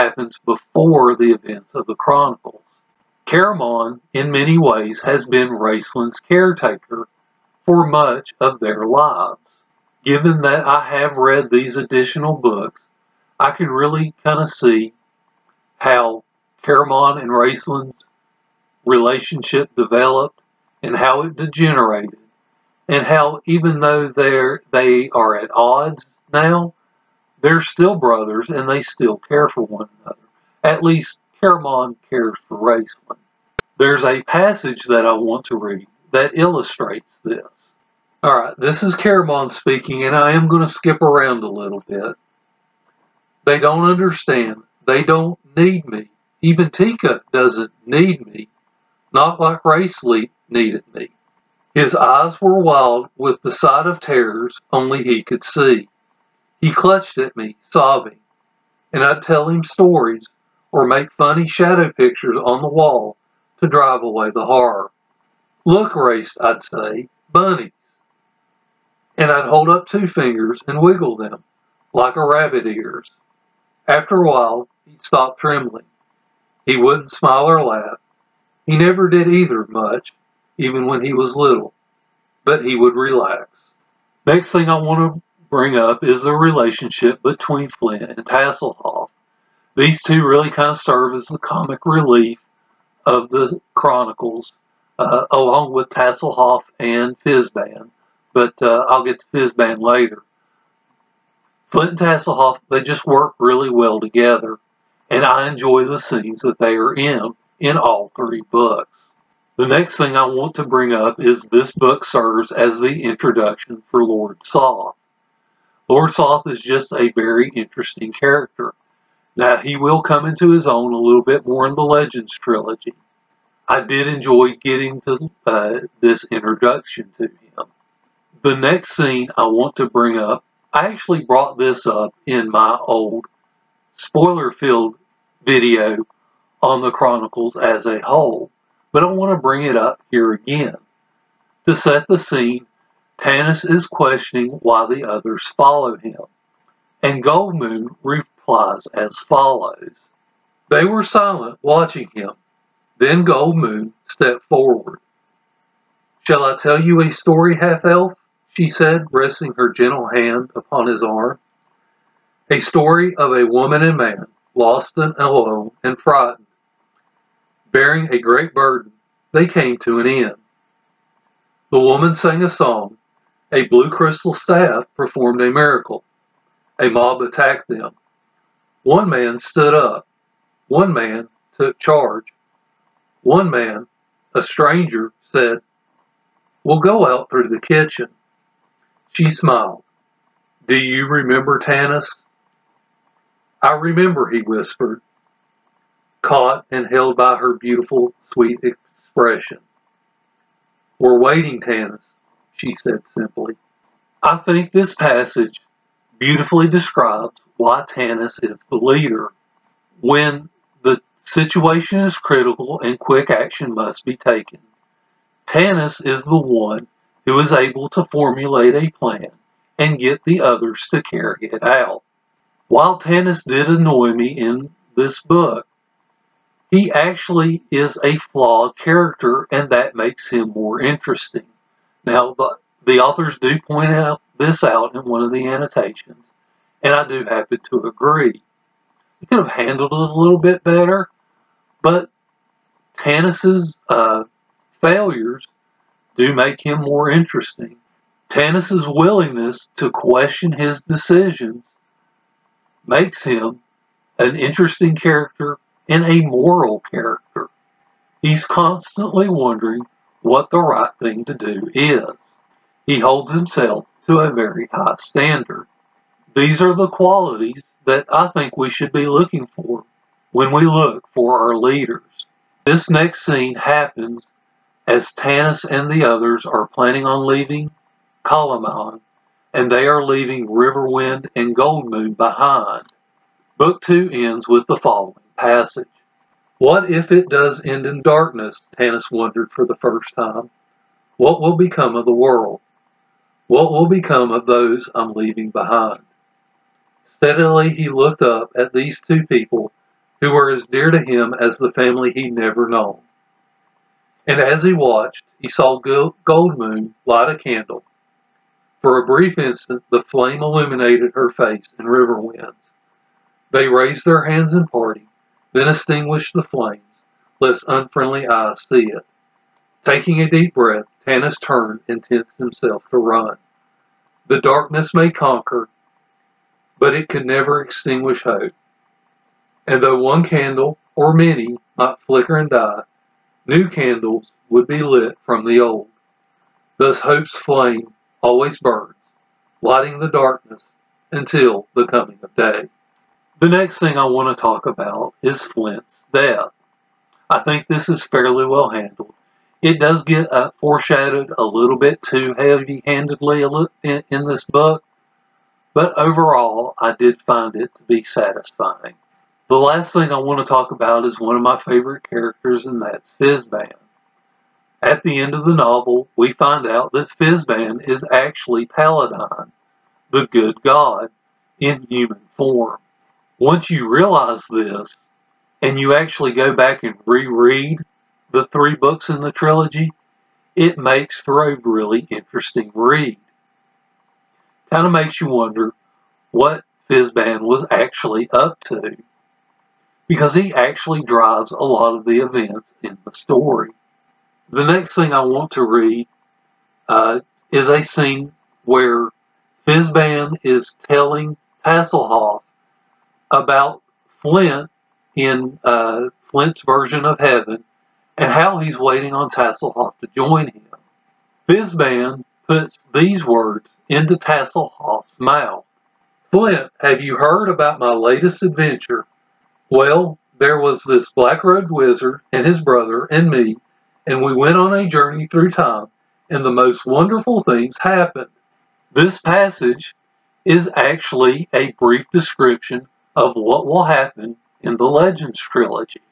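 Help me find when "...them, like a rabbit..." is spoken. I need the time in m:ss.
1:11.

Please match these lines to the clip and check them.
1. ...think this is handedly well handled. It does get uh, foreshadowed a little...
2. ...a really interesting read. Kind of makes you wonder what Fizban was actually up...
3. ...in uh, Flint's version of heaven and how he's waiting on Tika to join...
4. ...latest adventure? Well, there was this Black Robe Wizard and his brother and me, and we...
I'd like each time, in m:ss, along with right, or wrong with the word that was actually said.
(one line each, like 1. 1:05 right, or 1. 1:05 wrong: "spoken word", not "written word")
1. 5:47 wrong: "fairly", not "handedly"
2. 6:21 right
3. 6:45 wrong: "Tasslehoff", not "Tika"
4. 6:57 right.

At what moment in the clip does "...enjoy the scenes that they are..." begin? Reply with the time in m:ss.
1:45.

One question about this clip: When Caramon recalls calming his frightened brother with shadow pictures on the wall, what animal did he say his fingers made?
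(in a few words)
bunnies.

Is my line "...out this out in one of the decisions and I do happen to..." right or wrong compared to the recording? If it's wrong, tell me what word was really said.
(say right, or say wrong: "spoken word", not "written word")
wrong: "annotations", not "decisions".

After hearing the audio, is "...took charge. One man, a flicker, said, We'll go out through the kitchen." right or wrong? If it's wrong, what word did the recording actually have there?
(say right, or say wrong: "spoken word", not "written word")
wrong: "stranger", not "flicker".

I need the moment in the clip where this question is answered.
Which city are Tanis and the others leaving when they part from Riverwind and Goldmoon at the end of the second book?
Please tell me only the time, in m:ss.
4:38.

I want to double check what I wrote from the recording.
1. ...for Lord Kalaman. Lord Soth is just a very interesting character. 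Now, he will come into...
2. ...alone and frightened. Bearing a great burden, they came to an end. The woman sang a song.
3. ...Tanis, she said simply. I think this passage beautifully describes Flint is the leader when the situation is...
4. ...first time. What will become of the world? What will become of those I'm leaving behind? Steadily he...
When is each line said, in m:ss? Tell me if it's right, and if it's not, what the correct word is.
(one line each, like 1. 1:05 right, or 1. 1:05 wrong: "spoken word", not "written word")
1. 1:53 wrong: "Soth", not "Kalaman"
2. 2:45 right
3. 3:21 wrong: "Tanis", not "Flint"
4. 4:49 right.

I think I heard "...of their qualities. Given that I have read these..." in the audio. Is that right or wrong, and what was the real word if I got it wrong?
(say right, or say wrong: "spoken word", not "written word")
wrong: "lives", not "qualities".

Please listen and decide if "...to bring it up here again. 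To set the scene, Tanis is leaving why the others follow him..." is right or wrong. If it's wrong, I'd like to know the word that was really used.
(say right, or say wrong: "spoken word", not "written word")
wrong: "questioning", not "leaving".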